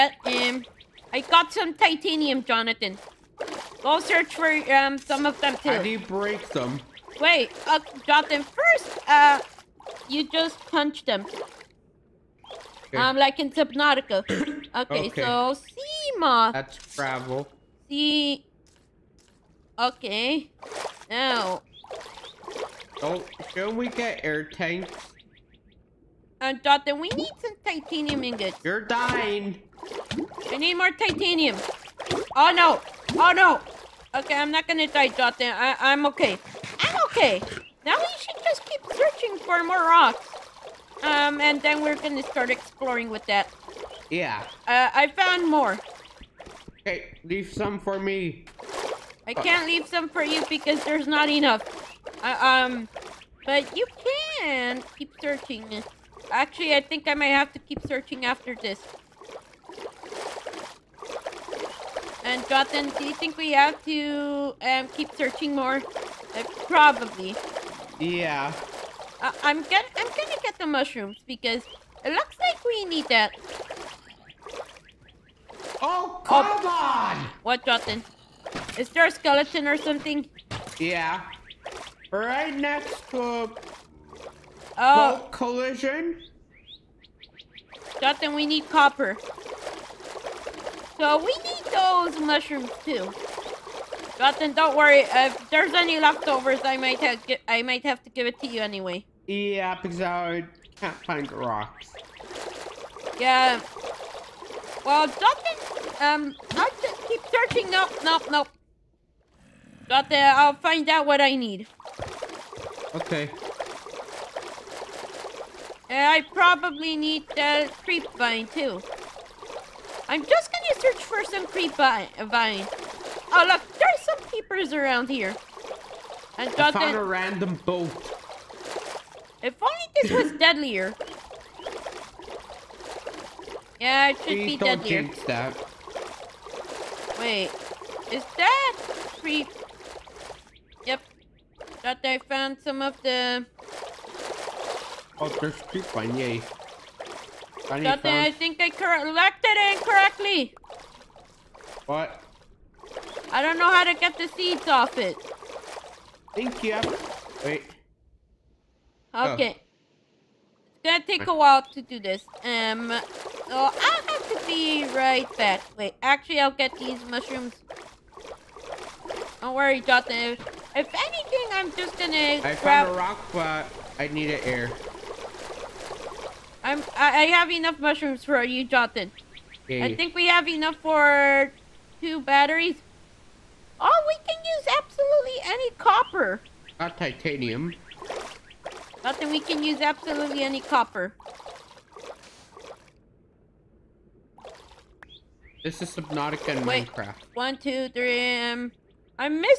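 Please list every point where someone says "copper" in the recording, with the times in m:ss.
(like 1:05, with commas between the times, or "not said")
1:28, 3:05, 3:10.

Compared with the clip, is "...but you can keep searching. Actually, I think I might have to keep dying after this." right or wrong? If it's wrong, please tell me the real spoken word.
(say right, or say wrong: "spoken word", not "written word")
wrong: "searching", not "dying".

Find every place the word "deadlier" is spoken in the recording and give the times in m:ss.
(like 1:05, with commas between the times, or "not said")
2:10, 2:14.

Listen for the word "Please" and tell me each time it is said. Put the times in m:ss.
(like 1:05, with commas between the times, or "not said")
2:14.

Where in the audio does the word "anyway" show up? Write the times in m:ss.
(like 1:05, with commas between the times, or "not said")
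1:38.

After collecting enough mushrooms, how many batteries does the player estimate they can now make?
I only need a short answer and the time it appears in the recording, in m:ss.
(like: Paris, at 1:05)
2, at 3:01.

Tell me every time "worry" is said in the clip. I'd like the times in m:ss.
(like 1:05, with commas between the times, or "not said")
1:34, 2:49.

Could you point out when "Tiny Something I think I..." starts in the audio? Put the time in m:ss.
2:27.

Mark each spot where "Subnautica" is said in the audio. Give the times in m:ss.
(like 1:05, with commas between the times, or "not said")
0:13, 3:15.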